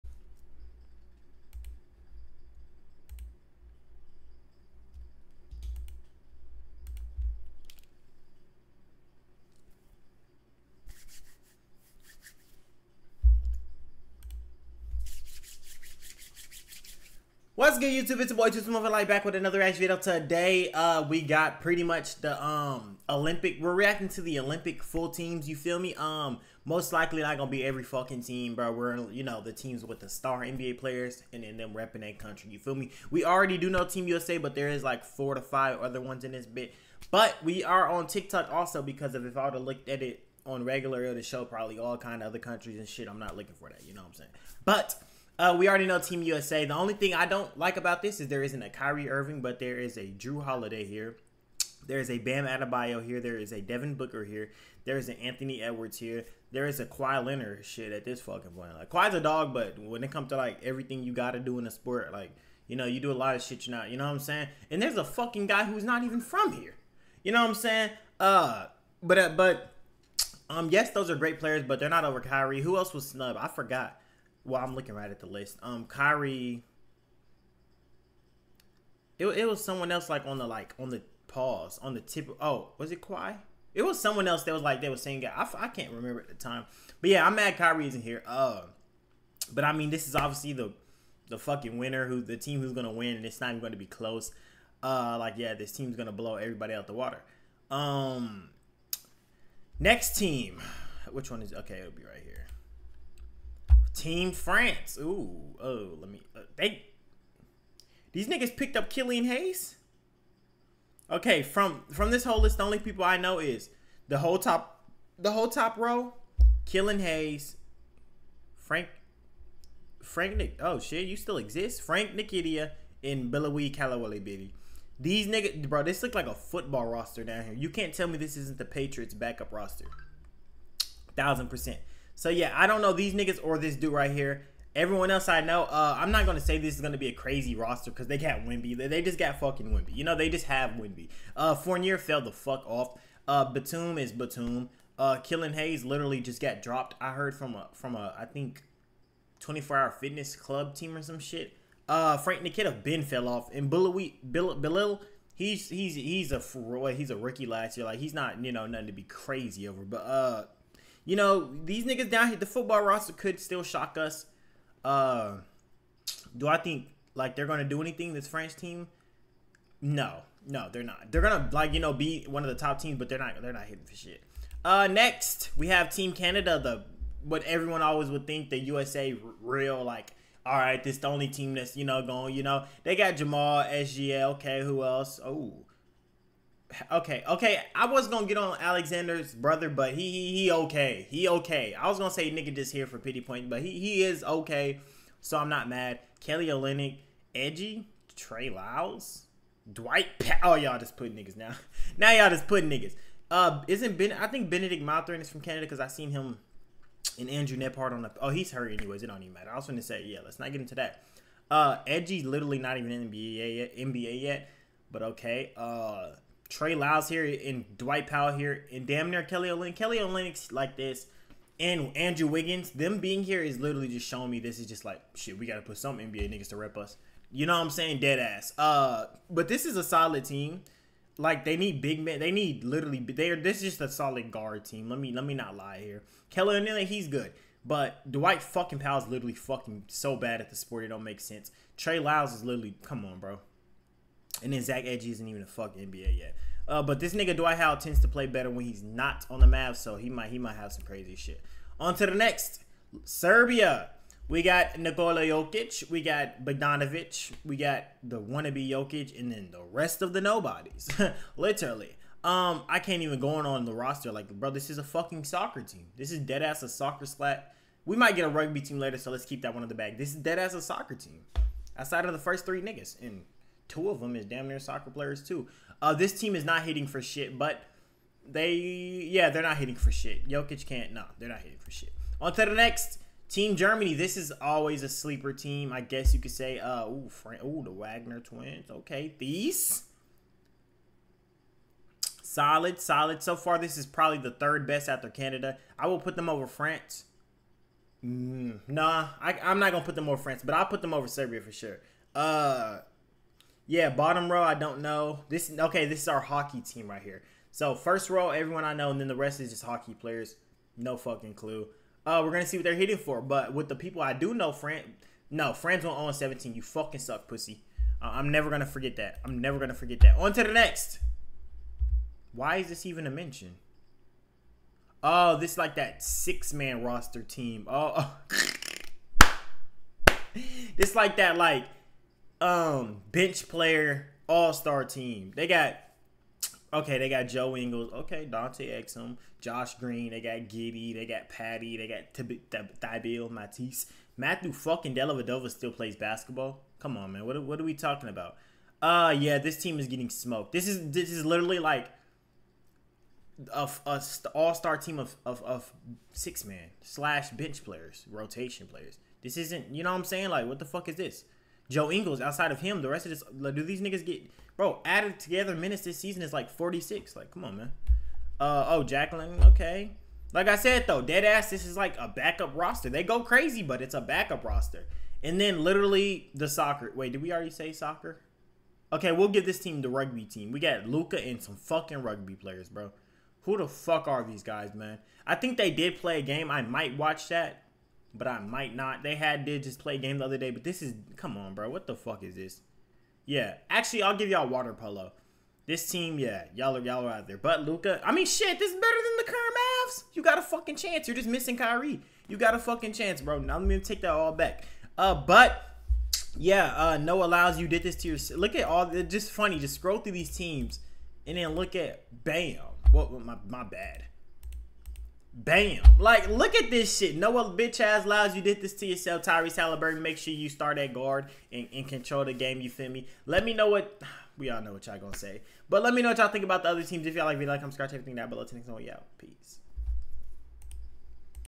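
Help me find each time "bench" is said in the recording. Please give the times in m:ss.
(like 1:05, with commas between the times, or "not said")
5:33, 5:57.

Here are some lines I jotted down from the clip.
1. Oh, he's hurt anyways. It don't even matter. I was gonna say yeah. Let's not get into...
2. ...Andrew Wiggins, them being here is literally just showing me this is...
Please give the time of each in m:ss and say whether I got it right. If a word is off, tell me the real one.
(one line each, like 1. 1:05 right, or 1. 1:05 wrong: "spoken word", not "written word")
1. 3:28 right
2. 3:41 right.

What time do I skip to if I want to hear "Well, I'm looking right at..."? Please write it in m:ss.
1:14.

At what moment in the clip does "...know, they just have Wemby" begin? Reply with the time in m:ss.
2:20.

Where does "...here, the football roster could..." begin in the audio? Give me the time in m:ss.
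2:42.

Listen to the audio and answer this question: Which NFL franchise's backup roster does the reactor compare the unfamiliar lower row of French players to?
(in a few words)
Patriots.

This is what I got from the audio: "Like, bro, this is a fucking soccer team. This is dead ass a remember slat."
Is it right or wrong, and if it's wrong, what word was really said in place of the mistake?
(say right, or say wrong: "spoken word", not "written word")
wrong: "soccer", not "remember".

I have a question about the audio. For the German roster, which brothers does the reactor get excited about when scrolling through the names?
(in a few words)
Wagner twins.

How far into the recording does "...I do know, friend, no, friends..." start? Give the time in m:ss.
5:14.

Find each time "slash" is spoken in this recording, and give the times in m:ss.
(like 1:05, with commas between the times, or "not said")
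5:56.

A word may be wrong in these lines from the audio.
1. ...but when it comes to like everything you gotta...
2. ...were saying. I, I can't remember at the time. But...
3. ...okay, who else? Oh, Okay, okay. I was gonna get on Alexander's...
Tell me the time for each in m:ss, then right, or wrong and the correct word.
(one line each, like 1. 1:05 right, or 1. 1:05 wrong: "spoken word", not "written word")
1. 0:59 right
2. 1:24 right
3. 3:04 right.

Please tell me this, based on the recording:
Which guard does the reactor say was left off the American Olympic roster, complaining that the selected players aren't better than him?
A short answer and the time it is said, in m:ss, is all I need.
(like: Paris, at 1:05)
Kyrie Irving, at 0:48.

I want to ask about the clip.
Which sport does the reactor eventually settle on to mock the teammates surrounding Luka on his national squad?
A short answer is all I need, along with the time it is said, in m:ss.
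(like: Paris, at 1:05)
water polo, at 6:34.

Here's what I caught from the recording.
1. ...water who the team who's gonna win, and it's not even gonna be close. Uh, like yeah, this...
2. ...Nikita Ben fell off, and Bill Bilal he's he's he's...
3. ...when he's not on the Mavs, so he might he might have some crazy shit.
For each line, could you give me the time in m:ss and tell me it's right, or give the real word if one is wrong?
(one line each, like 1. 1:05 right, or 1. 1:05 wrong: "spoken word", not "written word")
1. 1:31 wrong: "winner", not "water"
2. 2:32 right
3. 4:08 right.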